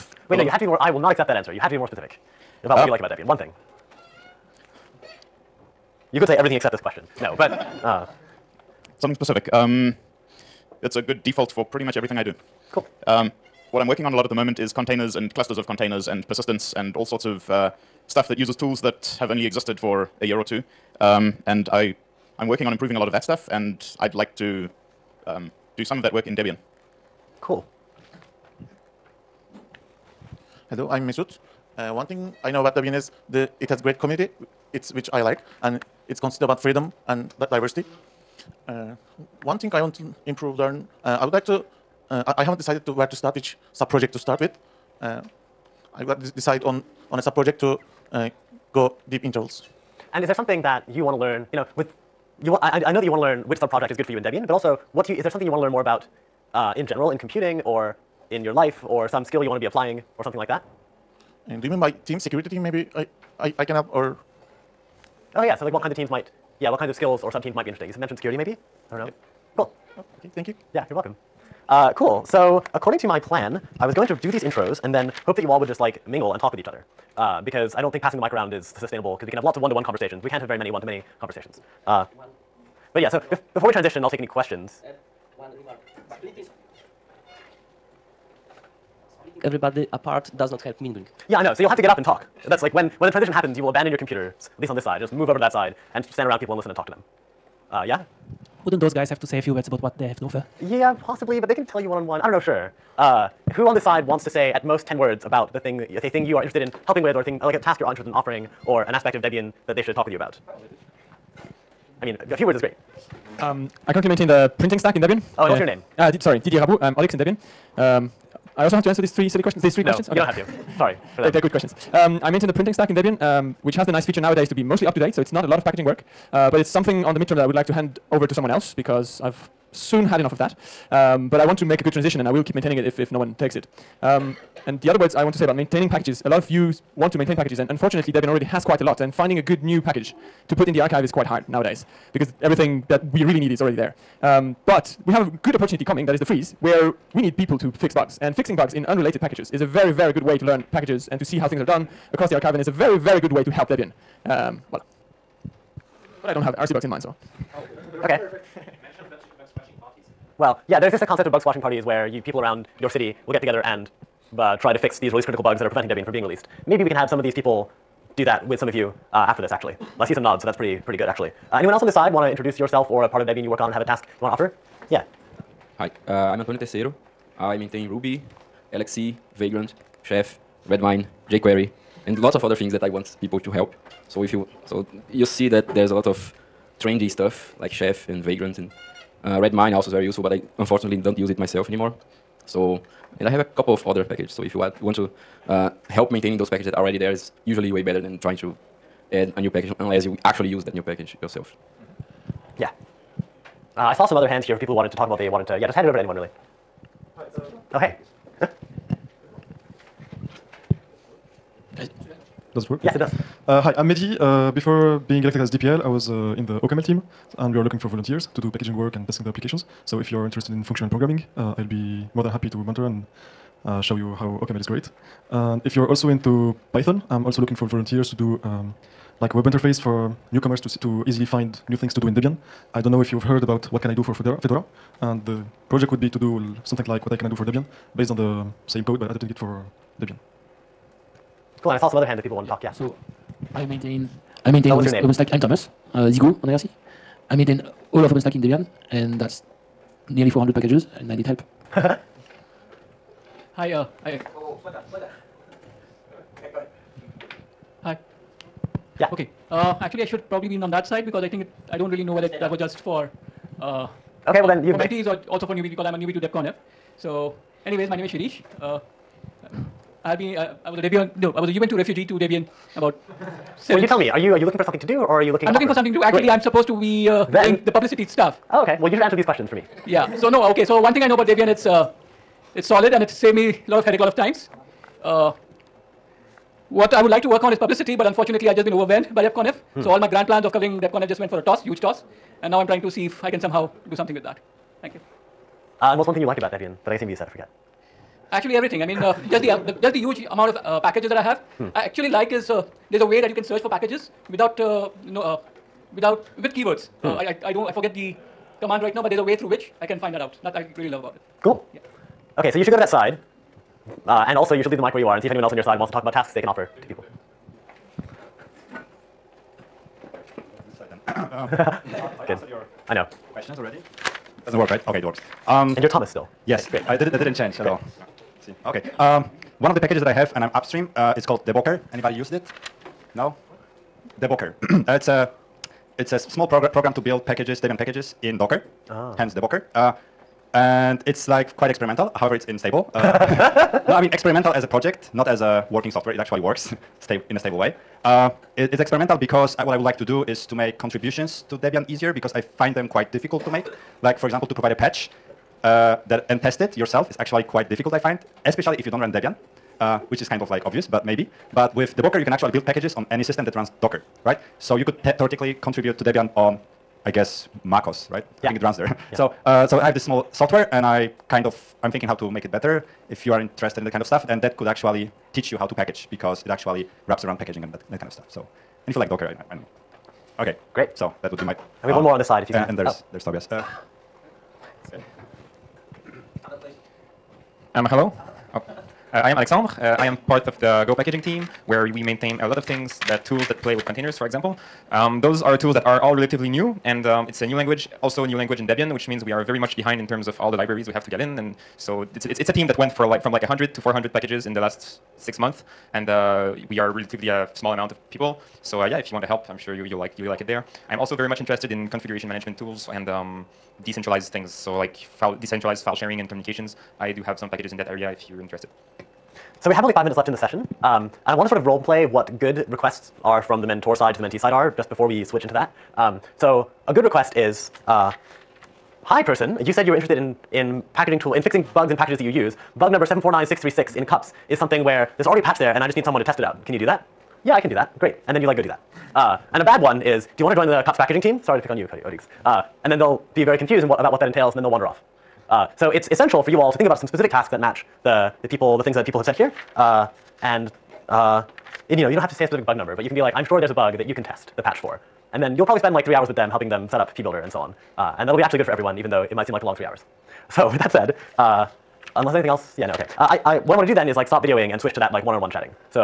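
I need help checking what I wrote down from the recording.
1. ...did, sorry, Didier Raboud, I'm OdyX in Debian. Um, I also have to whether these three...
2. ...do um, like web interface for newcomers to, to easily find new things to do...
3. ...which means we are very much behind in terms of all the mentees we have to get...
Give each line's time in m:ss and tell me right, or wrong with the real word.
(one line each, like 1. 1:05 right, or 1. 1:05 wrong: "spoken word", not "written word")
1. 1:56 wrong: "answer", not "whether"
2. 3:48 right
3. 6:38 wrong: "libraries", not "mentees".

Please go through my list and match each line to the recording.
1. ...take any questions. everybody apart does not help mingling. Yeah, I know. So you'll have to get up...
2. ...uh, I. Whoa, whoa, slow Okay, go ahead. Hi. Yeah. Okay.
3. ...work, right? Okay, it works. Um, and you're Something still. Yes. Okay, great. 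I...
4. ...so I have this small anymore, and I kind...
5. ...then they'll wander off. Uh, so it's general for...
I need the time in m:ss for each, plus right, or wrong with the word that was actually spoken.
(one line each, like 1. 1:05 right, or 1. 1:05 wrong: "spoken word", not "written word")
1. 1:24 right
2. 4:13 right
3. 5:24 wrong: "Thomas", not "Something"
4. 6:09 wrong: "software", not "anymore"
5. 7:24 wrong: "essential", not "general".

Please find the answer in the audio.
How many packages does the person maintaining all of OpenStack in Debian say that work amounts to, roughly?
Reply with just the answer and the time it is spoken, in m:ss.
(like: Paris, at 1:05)
400, at 4:10.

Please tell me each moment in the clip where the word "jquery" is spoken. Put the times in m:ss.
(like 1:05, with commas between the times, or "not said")
3:01.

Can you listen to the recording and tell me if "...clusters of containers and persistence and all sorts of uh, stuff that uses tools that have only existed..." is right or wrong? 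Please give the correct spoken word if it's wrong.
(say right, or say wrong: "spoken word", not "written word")
right.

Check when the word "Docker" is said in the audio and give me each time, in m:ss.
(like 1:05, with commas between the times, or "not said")
5:38, 6:03, 6:19.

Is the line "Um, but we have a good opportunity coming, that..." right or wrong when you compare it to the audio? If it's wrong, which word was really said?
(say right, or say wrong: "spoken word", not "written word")
right.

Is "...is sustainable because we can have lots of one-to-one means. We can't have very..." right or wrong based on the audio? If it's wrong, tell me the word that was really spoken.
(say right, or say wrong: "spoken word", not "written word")
wrong: "conversations", not "means".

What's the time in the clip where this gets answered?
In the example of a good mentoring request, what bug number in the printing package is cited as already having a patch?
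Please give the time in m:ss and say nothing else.
7:13.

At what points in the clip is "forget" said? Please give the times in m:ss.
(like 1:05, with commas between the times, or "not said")
4:57, 5:07.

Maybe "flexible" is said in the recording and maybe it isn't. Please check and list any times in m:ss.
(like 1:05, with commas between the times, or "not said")
not said.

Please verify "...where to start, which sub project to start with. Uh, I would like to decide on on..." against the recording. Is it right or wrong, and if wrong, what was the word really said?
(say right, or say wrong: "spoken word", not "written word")
right.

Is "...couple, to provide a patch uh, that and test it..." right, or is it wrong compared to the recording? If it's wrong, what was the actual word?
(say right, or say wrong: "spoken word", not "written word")
wrong: "example", not "couple".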